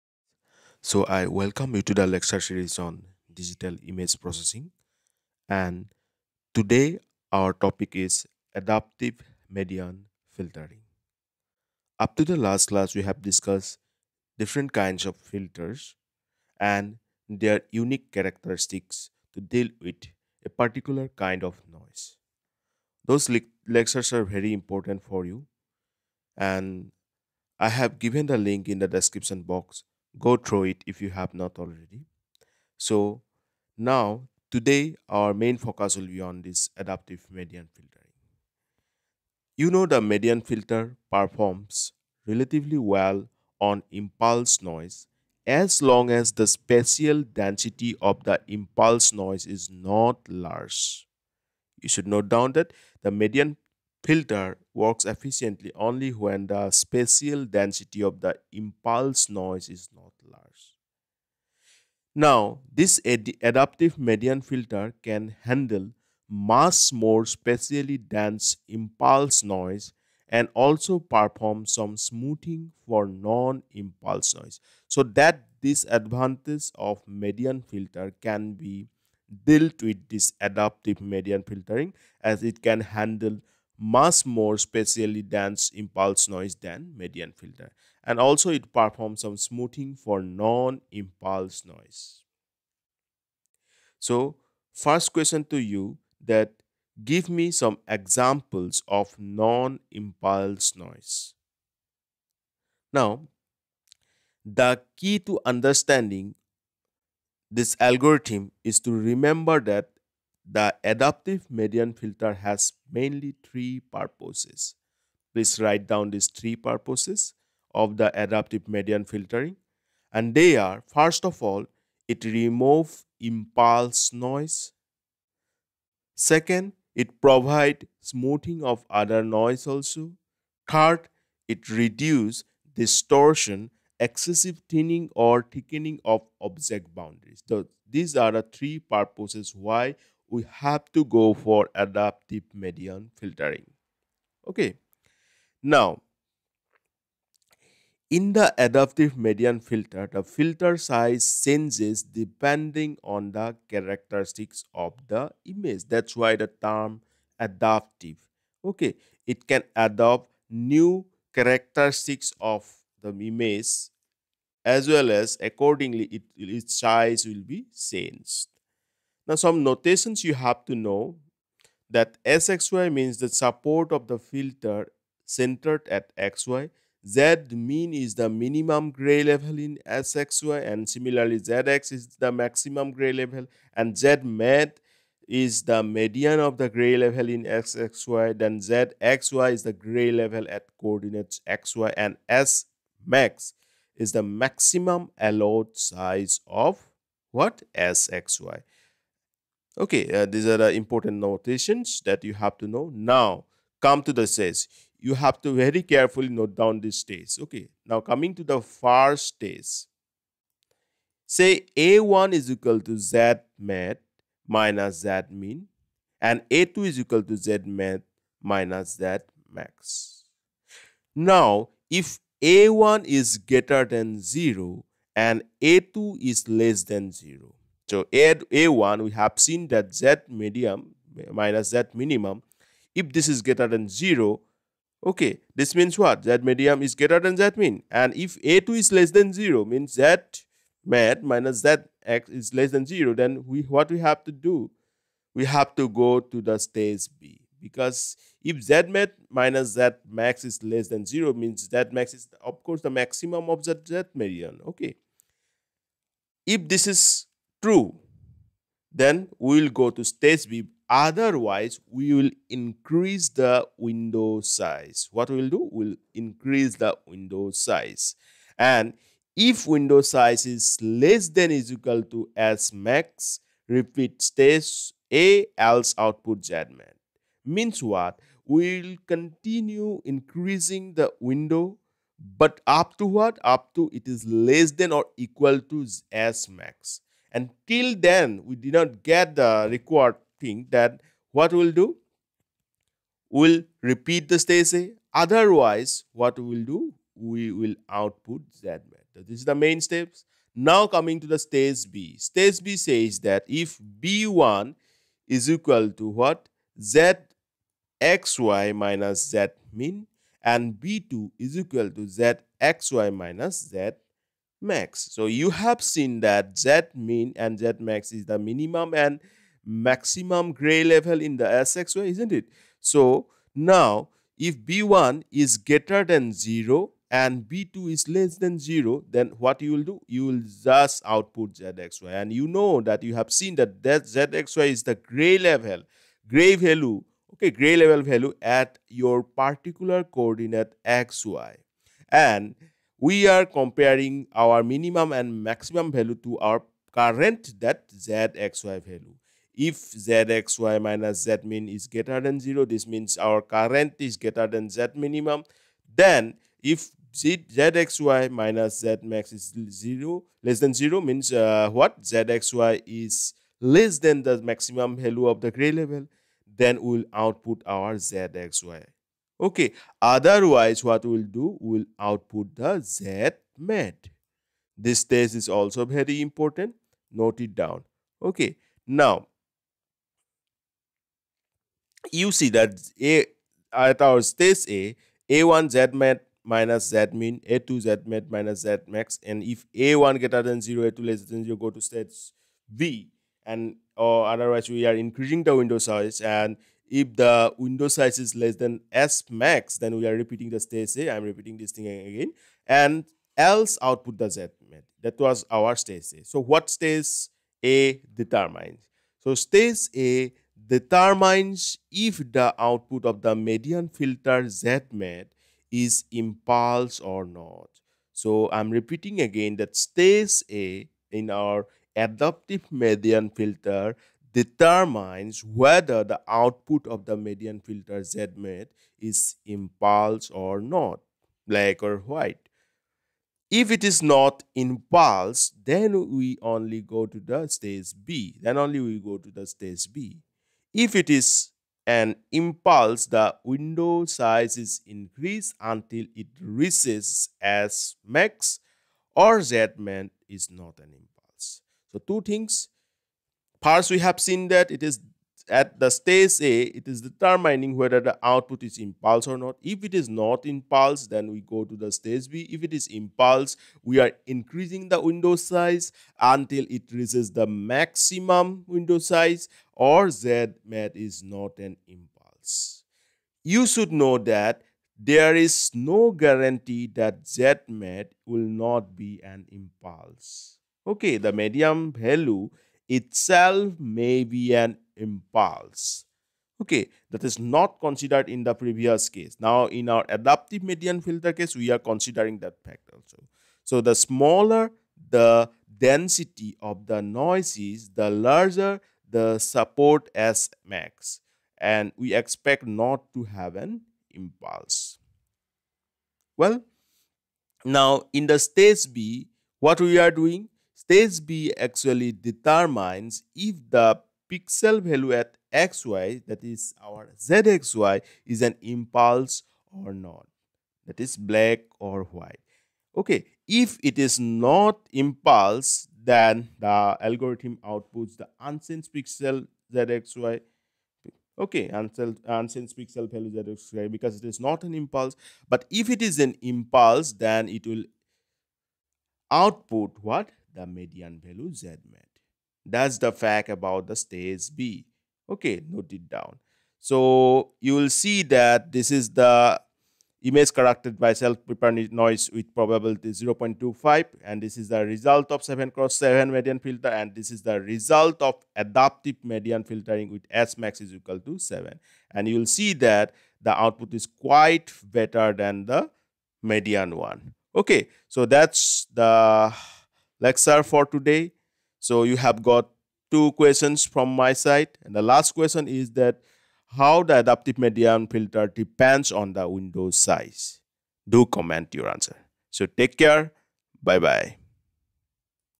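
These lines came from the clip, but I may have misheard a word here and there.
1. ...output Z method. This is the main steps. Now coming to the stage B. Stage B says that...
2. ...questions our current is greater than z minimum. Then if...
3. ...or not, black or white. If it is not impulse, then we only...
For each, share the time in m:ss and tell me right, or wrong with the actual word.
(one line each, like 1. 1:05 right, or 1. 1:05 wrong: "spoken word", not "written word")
1. 4:57 right
2. 5:52 wrong: "means", not "questions"
3. 7:10 right.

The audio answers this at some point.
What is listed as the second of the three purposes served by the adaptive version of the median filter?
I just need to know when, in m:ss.
2:07.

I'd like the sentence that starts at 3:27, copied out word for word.
Okay, now coming to the first stage.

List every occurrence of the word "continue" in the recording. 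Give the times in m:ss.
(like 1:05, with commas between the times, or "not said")
4:39.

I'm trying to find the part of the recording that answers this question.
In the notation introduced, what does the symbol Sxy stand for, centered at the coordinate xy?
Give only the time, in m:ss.
2:53.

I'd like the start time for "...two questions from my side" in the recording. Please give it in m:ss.
9:33.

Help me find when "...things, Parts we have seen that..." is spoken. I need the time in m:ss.
7:32.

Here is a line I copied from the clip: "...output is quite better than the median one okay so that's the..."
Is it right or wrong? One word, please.
right.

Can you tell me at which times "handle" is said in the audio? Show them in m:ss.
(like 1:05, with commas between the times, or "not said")
1:05, 1:22.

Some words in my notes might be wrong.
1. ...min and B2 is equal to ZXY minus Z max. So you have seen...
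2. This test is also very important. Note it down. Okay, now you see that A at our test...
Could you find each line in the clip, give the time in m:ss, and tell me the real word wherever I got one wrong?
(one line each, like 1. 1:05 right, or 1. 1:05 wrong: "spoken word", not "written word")
1. 5:09 right
2. 6:14 right.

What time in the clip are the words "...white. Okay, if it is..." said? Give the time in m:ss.
8:42.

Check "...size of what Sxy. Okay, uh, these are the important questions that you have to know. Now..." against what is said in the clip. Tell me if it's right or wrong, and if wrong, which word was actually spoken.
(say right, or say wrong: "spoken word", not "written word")
wrong: "notations", not "questions".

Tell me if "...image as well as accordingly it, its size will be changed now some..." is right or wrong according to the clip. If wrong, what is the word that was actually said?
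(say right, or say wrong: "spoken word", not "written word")
right.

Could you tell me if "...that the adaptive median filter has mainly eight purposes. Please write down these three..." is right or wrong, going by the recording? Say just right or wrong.
wrong.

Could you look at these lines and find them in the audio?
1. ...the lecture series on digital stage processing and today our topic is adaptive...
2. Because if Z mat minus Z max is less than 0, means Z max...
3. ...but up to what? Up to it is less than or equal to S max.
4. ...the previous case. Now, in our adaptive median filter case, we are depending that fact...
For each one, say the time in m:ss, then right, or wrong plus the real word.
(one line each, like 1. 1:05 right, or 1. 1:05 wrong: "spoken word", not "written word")
1. 0:01 wrong: "image", not "stage"
2. 4:07 right
3. 4:42 right
4. 8:08 wrong: "considering", not "depending".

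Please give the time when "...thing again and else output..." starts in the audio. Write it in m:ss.
6:41.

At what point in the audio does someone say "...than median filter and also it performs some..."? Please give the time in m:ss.
1:26.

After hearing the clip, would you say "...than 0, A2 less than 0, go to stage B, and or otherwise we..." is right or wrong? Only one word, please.
right.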